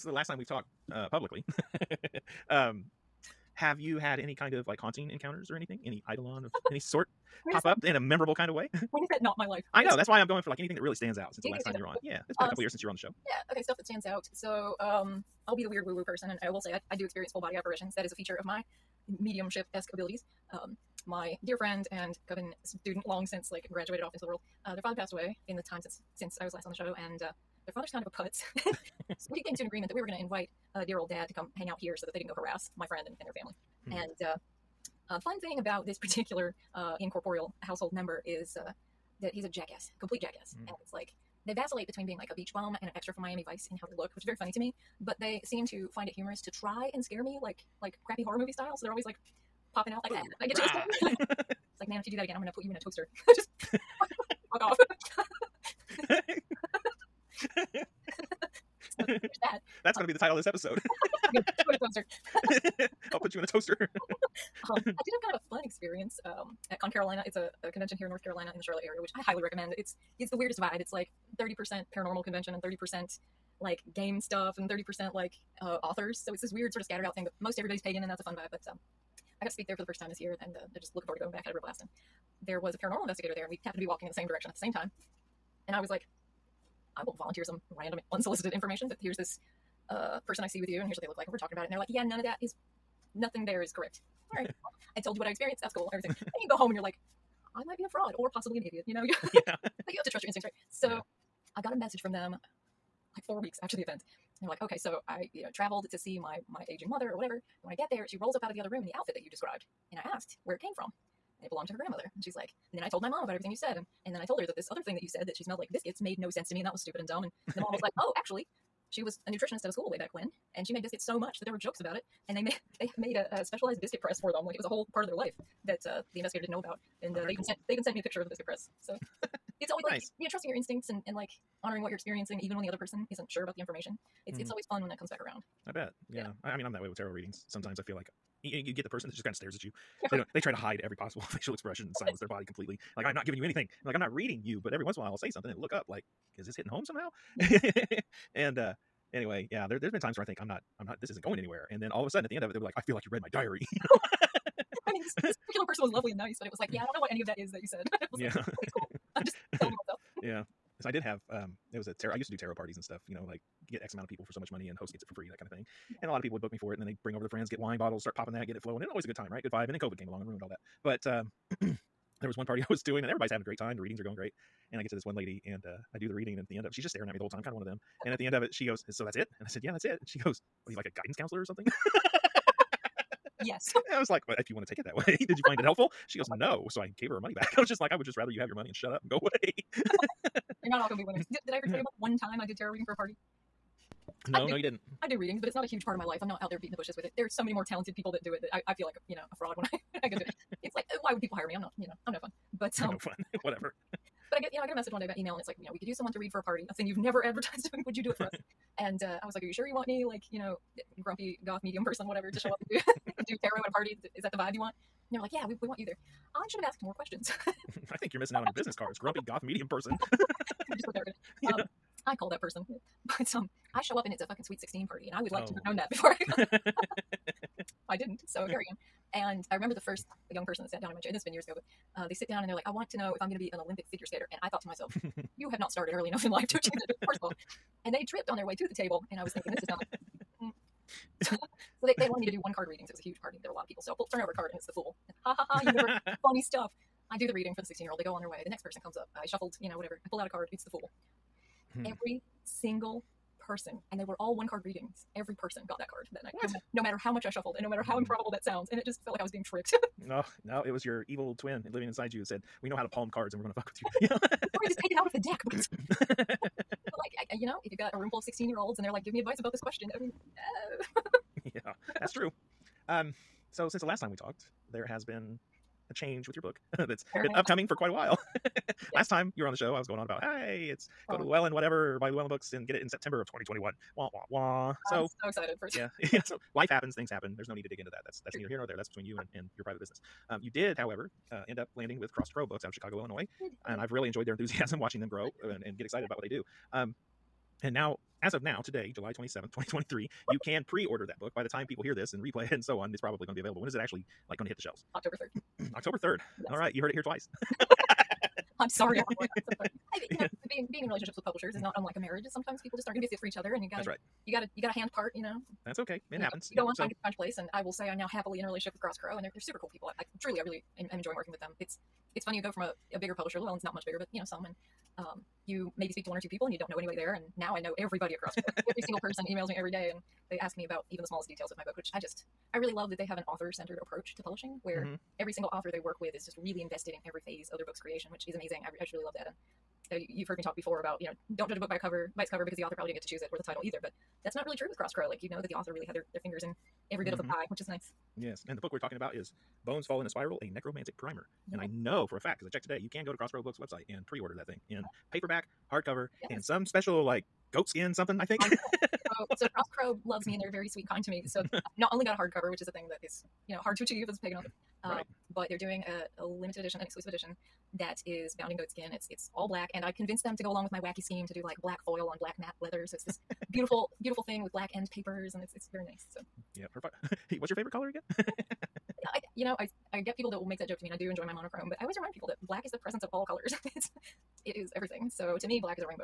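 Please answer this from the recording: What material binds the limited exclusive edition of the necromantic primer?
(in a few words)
goatskin.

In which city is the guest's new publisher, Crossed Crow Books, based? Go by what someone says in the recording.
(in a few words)
Chicago.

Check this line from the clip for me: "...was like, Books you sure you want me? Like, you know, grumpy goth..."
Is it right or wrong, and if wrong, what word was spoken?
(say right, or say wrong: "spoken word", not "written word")
wrong: "Are", not "Books".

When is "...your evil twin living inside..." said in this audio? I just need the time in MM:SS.
04:20.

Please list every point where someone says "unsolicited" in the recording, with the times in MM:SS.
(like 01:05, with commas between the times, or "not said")
01:28.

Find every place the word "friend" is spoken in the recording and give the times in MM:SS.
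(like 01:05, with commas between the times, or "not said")
00:21, 00:32, 02:47.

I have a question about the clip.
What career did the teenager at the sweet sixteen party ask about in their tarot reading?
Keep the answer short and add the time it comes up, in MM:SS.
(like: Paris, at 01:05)
Olympic figure skater, at 03:53.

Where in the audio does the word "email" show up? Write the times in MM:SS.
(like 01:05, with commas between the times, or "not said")
03:25, 05:29.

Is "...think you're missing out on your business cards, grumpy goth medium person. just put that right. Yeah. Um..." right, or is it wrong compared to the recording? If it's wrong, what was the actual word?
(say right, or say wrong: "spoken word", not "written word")
right.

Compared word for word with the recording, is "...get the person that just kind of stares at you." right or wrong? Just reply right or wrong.
right.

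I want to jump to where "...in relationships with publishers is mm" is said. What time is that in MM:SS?
05:10.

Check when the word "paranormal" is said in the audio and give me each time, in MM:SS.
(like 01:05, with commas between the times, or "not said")
01:11, 01:22.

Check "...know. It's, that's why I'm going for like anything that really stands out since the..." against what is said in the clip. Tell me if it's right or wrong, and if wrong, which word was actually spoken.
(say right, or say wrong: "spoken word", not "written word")
right.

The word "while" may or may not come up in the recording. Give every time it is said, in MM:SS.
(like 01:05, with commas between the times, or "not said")
02:25, 04:37.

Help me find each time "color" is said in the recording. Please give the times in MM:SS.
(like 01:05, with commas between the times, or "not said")
06:17, 06:23.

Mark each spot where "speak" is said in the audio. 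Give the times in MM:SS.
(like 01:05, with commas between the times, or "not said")
01:19, 05:25.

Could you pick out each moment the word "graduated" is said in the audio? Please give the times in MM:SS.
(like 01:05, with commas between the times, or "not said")
00:23.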